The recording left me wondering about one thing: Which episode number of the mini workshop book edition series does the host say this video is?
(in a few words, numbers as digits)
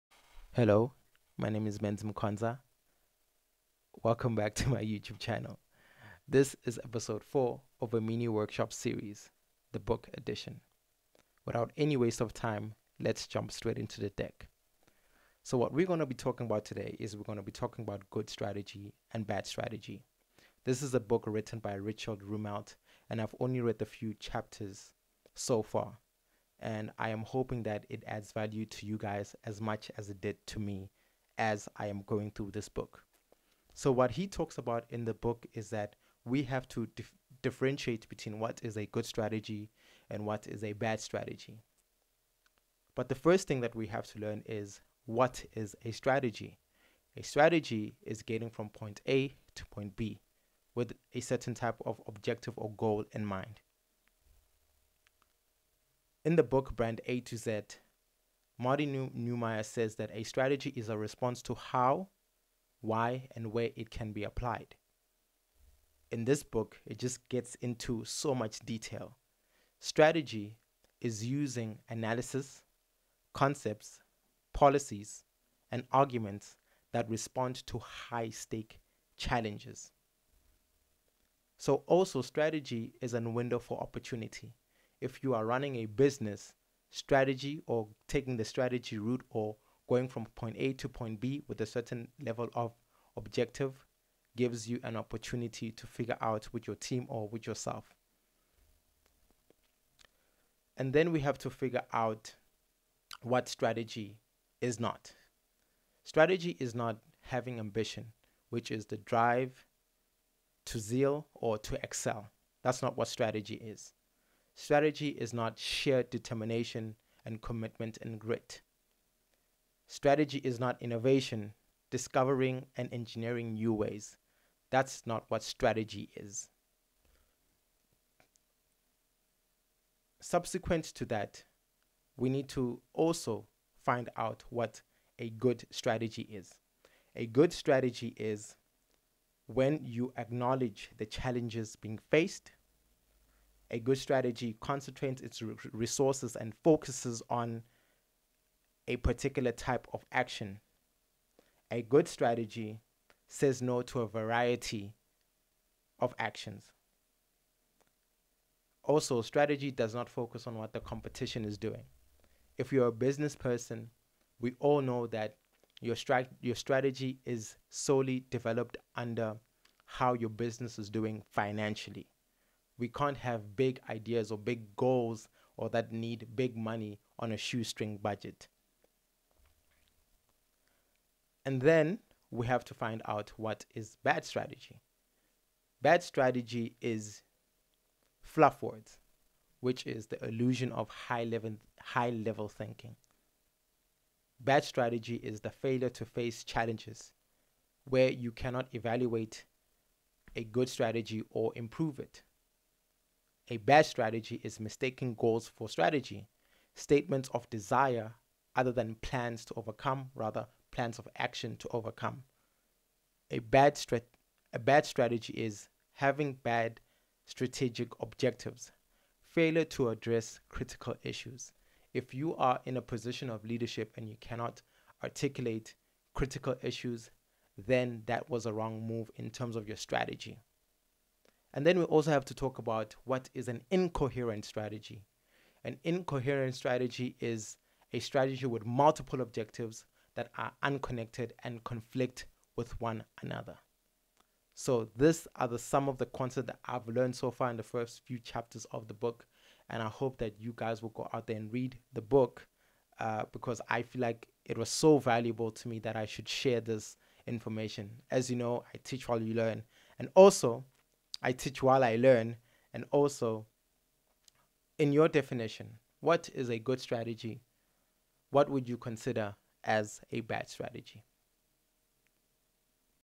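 4.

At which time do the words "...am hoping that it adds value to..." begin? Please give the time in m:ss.
0:27.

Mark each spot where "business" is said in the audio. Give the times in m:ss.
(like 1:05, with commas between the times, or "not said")
1:25, 2:42, 2:50.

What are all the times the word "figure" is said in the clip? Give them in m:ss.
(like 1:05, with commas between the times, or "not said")
1:35, 1:41.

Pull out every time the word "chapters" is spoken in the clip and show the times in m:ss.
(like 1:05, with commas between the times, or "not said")
0:24, 4:08.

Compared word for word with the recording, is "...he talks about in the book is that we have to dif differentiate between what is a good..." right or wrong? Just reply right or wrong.
right.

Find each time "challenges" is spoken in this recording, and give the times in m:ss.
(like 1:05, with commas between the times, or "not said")
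1:19, 2:21, 3:16.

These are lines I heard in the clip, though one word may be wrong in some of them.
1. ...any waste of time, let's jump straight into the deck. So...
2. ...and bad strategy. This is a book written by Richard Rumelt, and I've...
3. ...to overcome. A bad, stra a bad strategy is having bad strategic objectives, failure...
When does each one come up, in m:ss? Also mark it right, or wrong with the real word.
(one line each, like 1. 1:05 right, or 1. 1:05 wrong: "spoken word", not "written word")
1. 0:11 right
2. 0:19 right
3. 3:31 right.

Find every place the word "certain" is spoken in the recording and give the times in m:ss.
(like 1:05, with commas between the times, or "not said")
0:51, 1:31.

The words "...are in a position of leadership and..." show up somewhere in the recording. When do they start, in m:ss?
3:42.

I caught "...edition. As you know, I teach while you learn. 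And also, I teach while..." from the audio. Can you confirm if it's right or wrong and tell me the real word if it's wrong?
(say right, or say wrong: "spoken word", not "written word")
wrong: "information", not "edition".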